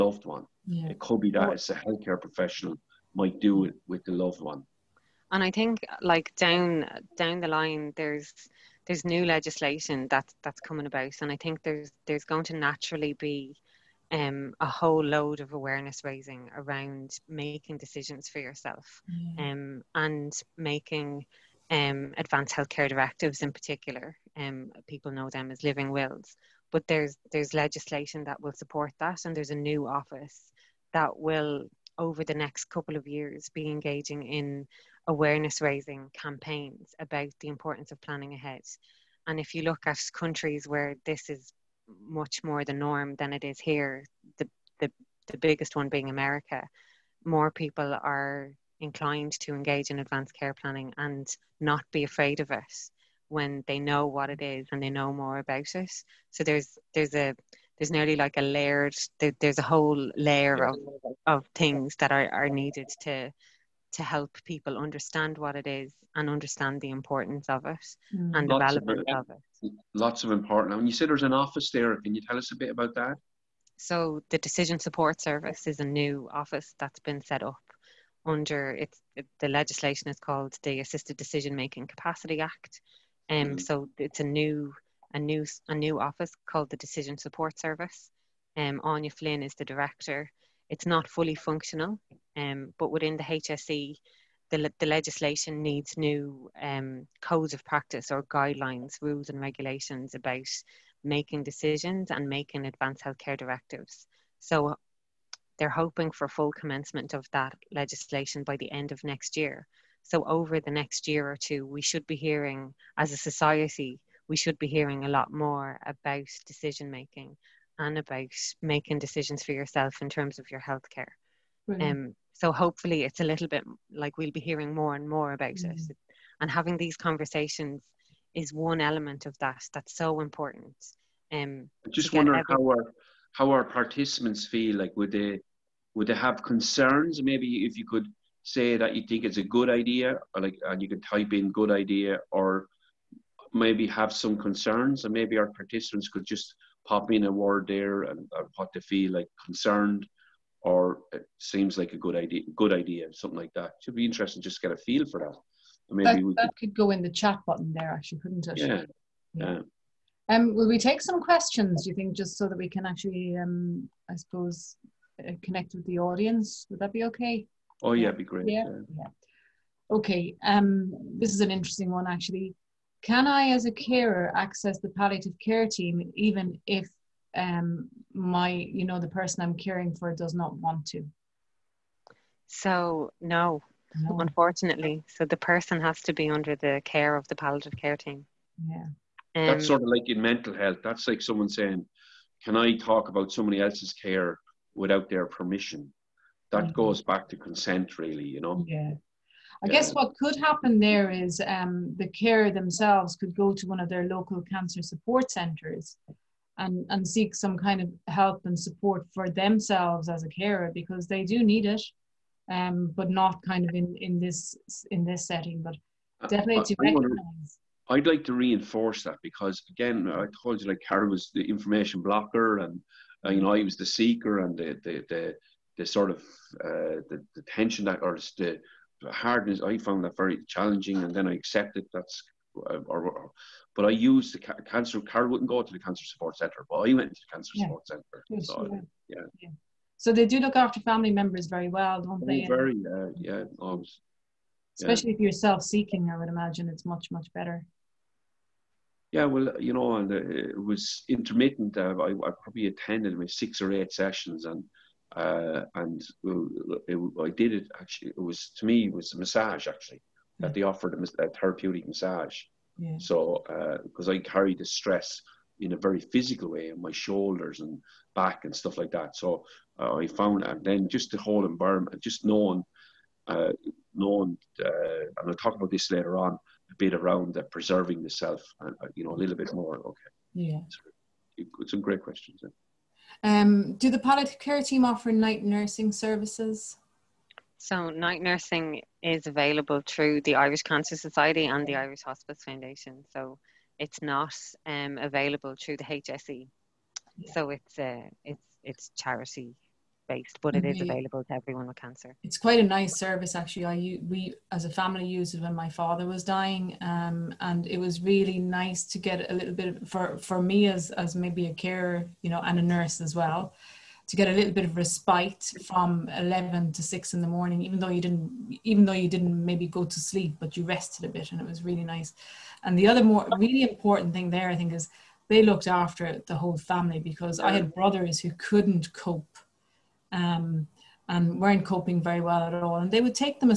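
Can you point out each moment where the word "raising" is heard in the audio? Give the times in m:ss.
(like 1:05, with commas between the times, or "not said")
0:16, 0:35.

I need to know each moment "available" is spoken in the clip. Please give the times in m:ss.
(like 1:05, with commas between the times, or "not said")
4:49, 4:54, 5:00.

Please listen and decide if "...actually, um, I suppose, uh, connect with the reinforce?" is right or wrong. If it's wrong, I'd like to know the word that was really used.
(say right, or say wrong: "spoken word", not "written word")
wrong: "audience", not "reinforce".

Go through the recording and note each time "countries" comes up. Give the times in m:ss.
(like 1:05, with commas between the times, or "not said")
0:40.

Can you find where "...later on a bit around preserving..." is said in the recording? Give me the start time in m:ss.
4:35.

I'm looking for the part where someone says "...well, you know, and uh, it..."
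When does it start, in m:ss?
4:09.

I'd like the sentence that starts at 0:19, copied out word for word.
um, and making um, advanced healthcare directives in particular.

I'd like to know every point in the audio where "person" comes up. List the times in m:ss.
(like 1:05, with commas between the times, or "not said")
2:59, 3:05.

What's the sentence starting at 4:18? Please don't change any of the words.
It was to me it was a massage actually that hmm.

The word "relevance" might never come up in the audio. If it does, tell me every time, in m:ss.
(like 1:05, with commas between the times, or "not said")
1:08.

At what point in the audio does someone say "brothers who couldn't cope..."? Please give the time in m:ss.
5:27.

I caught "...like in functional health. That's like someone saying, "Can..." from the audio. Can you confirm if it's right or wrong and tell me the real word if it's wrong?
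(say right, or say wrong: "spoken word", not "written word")
wrong: "mental", not "functional".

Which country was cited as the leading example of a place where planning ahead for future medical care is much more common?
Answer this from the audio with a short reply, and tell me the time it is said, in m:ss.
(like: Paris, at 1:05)
America, at 0:46.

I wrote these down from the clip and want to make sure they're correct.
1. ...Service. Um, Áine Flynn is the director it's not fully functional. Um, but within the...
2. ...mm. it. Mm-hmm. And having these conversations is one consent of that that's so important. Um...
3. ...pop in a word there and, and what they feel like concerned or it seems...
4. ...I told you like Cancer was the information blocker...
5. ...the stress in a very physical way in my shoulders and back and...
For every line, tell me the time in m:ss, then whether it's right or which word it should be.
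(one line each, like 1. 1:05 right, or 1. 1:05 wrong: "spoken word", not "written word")
1. 1:27 right
2. 2:05 wrong: "element", not "consent"
3. 2:26 right
4. 3:40 wrong: "Carrie", not "Cancer"
5. 4:24 right.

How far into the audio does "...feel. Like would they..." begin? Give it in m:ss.
2:14.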